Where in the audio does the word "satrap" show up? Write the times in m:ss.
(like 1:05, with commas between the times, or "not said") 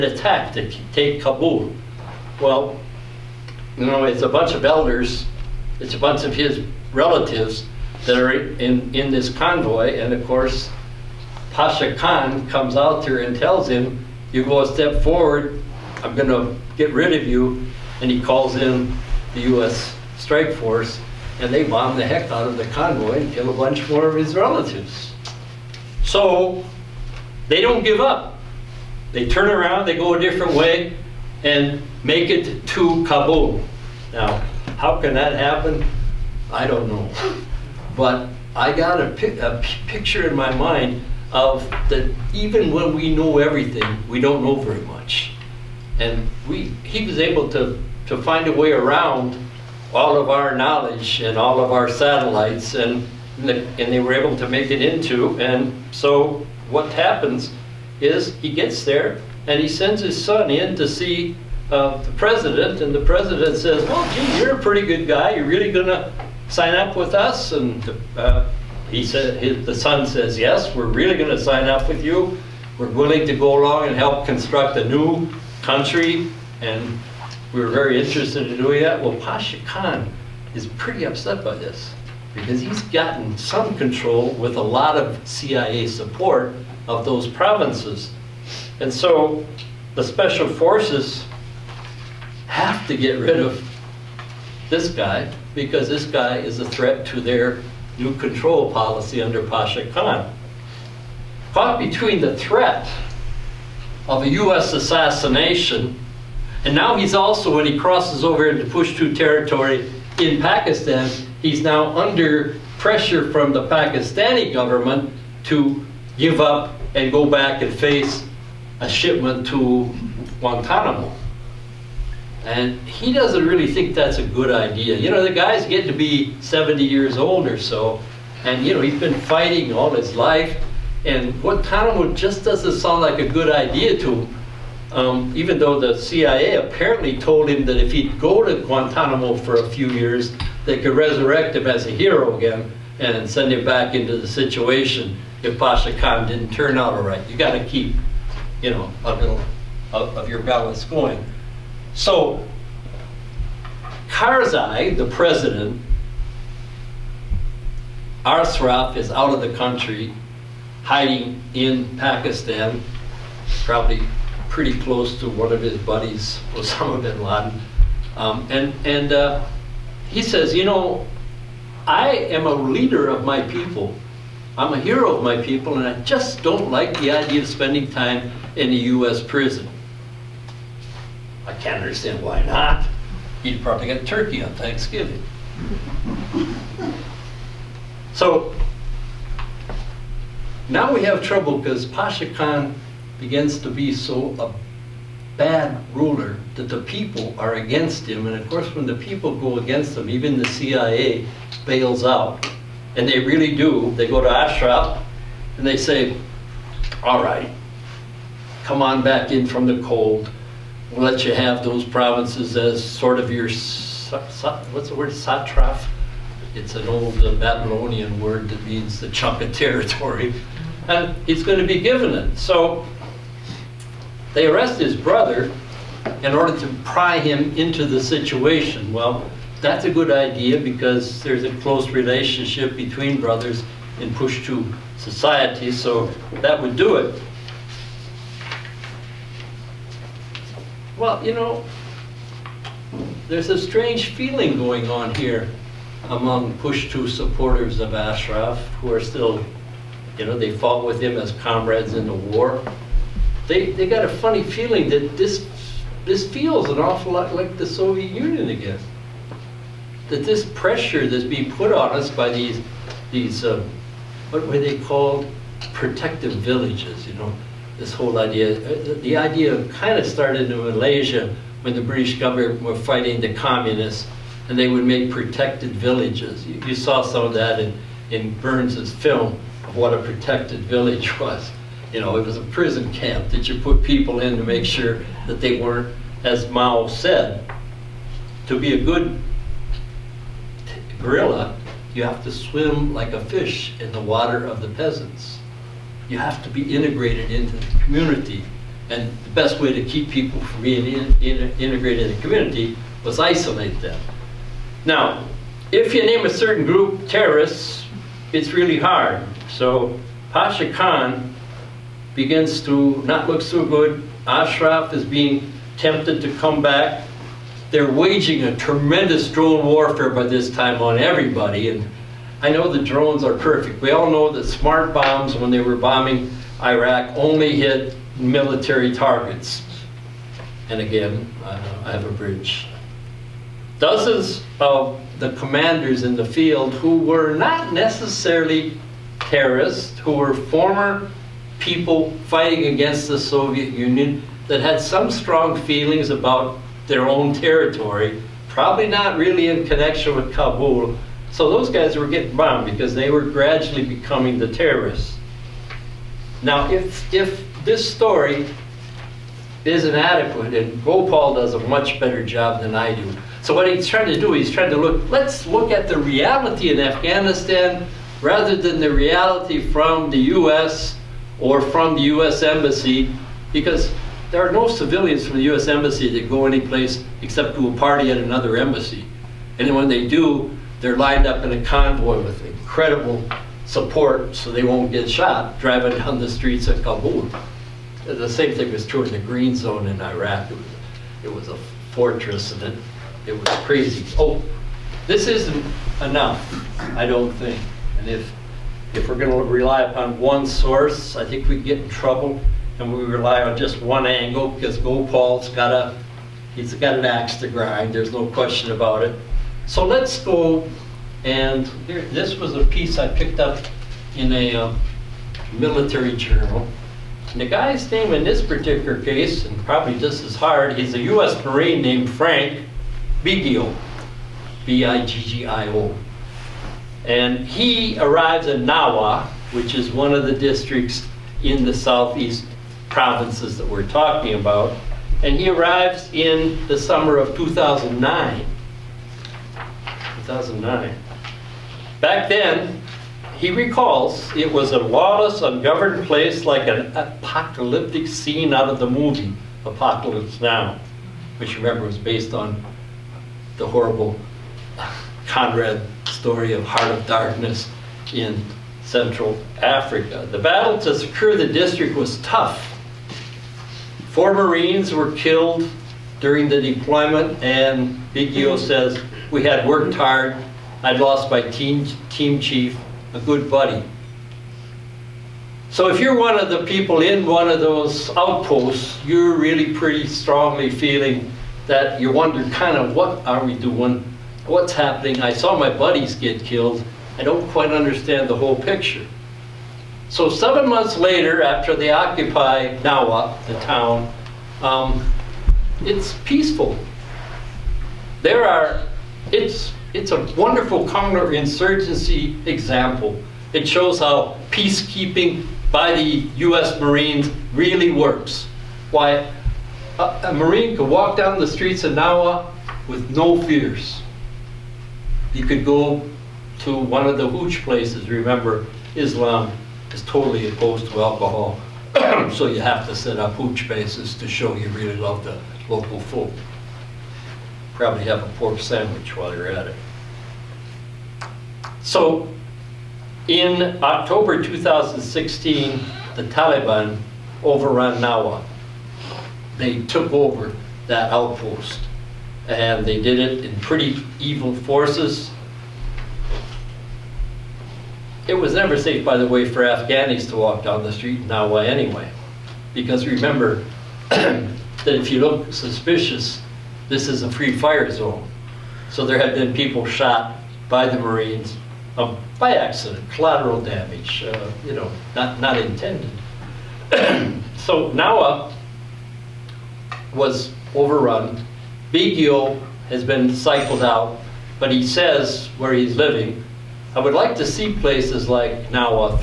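3:35.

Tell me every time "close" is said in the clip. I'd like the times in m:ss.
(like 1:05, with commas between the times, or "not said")
2:44, 3:51.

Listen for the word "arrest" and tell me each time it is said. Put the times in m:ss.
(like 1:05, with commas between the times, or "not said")
3:44.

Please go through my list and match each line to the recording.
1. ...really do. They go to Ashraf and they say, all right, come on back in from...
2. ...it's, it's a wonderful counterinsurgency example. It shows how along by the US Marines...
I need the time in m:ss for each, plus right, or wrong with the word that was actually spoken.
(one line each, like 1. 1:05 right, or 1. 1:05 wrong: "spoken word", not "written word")
1. 3:23 right
2. 8:19 wrong: "peacekeeping", not "along".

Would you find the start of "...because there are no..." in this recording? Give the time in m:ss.
6:13.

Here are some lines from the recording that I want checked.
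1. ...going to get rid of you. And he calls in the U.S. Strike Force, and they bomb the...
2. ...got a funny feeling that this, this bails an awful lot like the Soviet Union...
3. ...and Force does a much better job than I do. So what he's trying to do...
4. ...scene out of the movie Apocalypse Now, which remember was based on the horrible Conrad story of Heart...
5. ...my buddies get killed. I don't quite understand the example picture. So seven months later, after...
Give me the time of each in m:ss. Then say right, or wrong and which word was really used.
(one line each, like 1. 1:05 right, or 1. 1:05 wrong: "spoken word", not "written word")
1. 0:16 right
2. 4:13 wrong: "feels", not "bails"
3. 6:00 wrong: "Gopal", not "Force"
4. 7:28 right
5. 8:05 wrong: "whole", not "example".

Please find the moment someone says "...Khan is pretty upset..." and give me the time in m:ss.
1:19.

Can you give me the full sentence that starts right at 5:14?
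Ashraf is being tempted to come back.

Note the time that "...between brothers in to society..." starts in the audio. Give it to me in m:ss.
3:52.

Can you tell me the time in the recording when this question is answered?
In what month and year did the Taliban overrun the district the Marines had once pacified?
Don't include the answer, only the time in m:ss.
8:53.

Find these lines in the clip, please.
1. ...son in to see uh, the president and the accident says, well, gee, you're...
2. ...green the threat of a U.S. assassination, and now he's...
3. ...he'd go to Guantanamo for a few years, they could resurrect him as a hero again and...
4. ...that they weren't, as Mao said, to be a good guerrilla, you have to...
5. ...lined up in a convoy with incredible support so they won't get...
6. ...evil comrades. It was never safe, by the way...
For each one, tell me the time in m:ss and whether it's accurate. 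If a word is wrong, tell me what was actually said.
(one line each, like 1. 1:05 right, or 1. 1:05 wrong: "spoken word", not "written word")
1. 1:00 wrong: "president", not "accident"
2. 1:41 wrong: "between", not "green"
3. 2:17 right
4. 4:45 right
5. 6:20 right
6. 9:04 wrong: "forces", not "comrades".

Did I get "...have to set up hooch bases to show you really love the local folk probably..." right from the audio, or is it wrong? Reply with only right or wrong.
right.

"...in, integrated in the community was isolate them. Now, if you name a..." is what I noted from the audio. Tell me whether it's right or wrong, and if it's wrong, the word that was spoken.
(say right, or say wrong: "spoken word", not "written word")
right.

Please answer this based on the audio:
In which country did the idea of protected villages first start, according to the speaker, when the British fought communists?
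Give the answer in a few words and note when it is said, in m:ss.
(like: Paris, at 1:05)
Malaysia, at 4:30.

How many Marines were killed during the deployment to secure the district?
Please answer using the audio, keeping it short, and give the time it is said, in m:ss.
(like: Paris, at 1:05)
4, at 7:44.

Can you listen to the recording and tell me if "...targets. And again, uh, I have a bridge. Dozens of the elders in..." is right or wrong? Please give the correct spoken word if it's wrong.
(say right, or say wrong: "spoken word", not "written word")
wrong: "commanders", not "elders".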